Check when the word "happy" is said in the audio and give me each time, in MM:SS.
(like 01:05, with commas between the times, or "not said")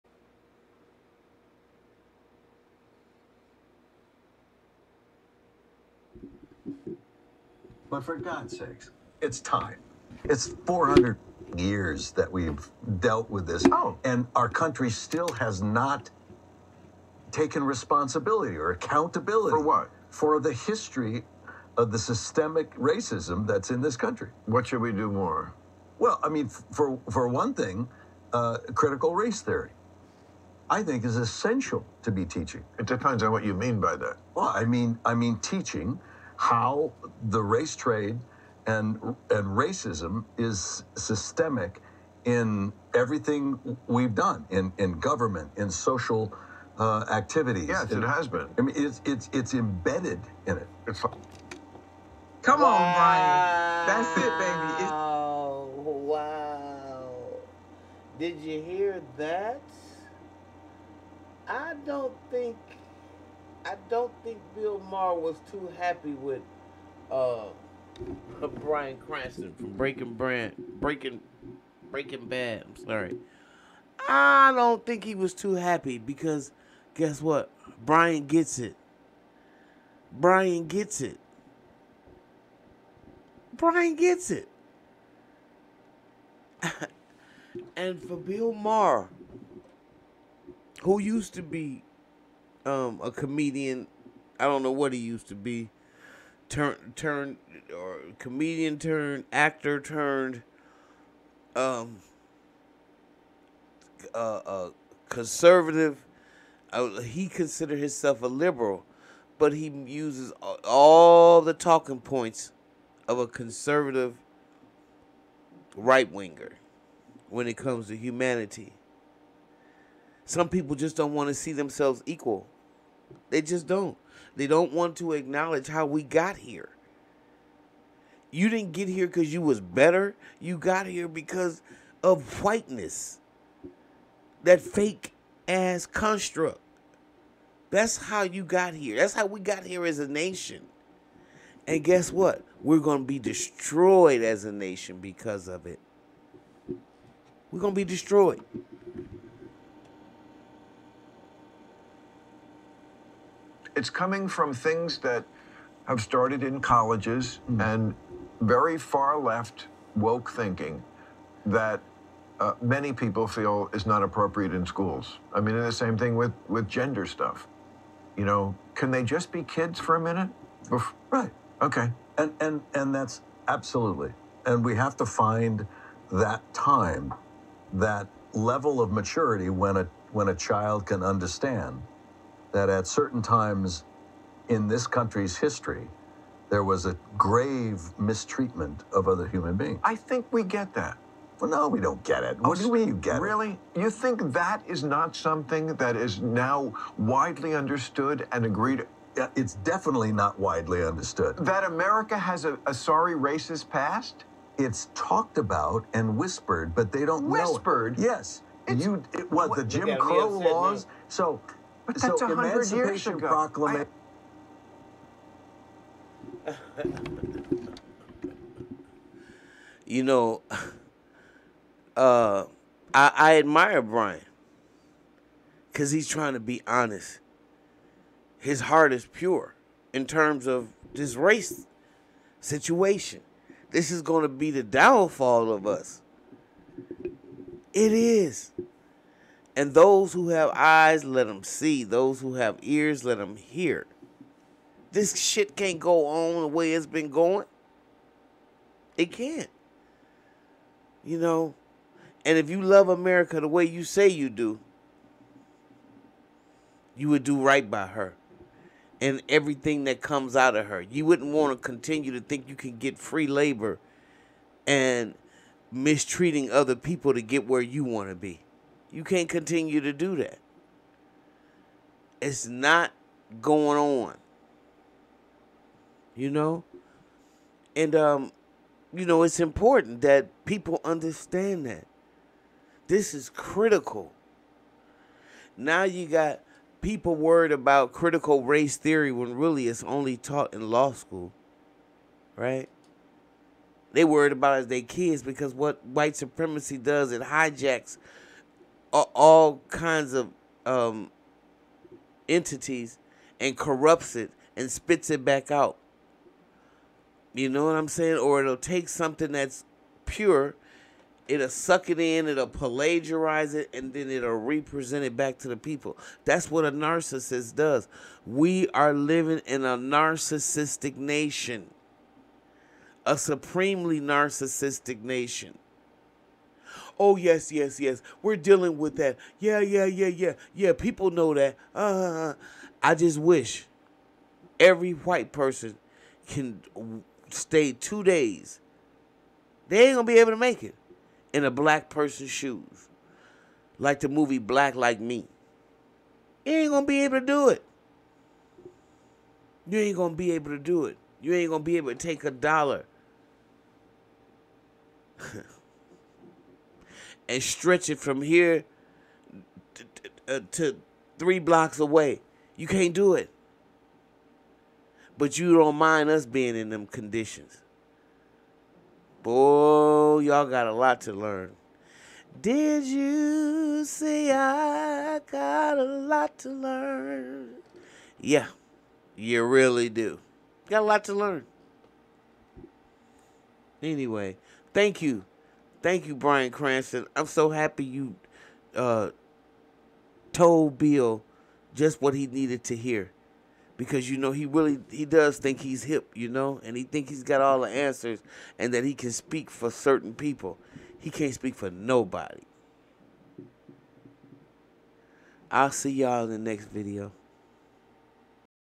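01:05, 01:15, 06:27.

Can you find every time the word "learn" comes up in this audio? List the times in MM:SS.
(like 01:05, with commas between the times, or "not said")
06:11, 06:16, 06:21.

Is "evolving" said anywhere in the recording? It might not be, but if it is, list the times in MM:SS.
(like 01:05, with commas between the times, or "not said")
not said.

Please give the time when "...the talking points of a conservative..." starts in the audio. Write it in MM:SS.
01:51.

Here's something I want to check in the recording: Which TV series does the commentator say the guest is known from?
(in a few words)
Breaking Bad.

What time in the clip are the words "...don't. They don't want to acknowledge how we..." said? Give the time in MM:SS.
02:03.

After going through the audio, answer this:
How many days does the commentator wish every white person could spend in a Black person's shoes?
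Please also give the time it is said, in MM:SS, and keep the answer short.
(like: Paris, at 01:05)
2, at 05:37.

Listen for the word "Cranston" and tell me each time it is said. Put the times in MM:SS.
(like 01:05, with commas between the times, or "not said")
01:09, 06:26.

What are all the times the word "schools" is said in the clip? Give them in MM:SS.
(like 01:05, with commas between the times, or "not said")
02:44, 04:50.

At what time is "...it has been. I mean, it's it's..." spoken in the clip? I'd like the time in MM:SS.
00:47.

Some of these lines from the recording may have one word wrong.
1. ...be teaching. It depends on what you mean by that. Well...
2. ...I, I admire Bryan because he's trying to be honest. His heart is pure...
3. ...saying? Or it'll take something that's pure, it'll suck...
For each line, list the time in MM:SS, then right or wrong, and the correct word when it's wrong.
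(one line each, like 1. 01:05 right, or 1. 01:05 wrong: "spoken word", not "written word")
1. 00:32 right
2. 03:42 right
3. 05:07 right.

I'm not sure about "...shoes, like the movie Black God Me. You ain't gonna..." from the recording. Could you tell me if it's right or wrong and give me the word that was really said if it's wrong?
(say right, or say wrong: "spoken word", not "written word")
wrong: "Like", not "God".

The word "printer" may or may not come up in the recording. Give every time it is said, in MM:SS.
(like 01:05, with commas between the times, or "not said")
not said.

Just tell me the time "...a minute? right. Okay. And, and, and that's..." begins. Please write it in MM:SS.
02:49.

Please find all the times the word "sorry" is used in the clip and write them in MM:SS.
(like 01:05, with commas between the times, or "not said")
01:12, 03:22.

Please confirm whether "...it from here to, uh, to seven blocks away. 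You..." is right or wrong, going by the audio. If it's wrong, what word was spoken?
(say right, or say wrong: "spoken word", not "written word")
wrong: "three", not "seven".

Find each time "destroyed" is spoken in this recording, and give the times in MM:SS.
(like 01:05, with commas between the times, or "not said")
02:23, 02:27.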